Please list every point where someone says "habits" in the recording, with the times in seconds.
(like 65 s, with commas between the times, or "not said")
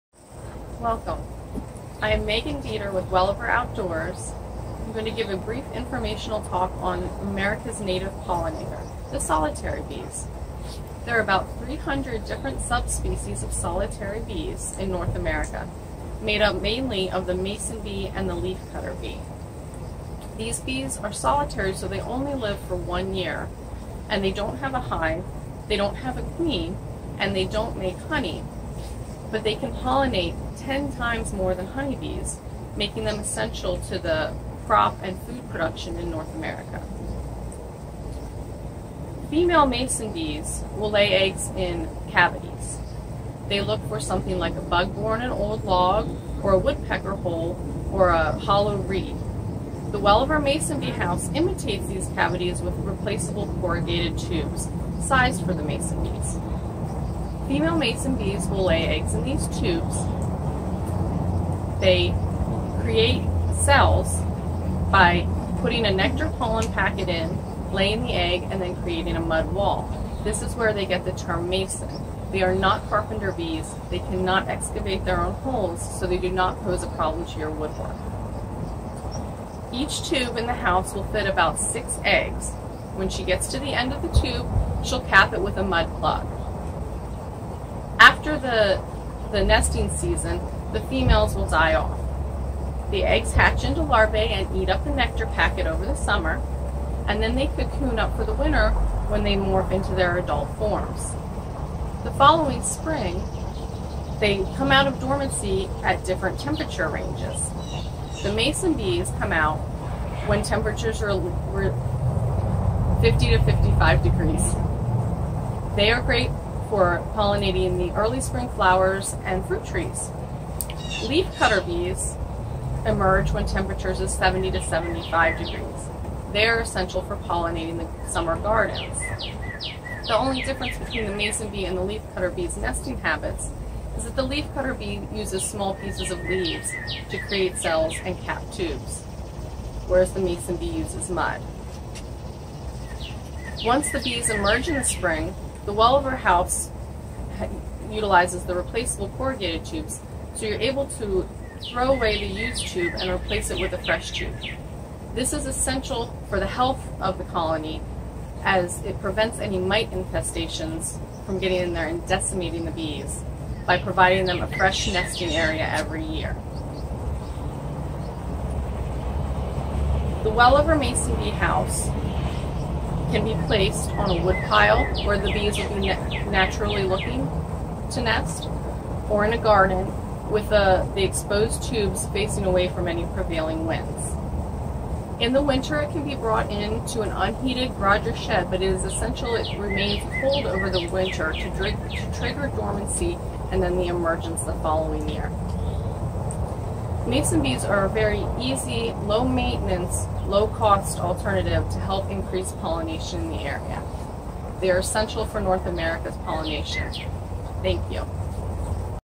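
133 s.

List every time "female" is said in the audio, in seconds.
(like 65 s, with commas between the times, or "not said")
39 s, 57 s, 90 s.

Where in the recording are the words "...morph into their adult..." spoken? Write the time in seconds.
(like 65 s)
99 s.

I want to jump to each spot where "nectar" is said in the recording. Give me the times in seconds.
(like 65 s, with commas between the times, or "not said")
65 s, 94 s.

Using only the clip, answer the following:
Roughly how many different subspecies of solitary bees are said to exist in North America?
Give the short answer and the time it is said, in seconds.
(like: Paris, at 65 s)
300, at 11 s.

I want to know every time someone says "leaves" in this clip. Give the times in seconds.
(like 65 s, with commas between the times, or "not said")
136 s.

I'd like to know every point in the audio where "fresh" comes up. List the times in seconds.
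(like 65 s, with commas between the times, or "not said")
153 s, 164 s.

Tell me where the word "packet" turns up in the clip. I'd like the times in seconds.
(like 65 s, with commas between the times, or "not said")
66 s, 95 s.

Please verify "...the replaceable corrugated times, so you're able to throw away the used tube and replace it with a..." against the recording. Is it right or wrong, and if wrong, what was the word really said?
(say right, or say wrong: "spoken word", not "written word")
wrong: "tubes", not "times".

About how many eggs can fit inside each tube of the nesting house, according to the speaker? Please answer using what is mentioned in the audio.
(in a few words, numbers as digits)
6.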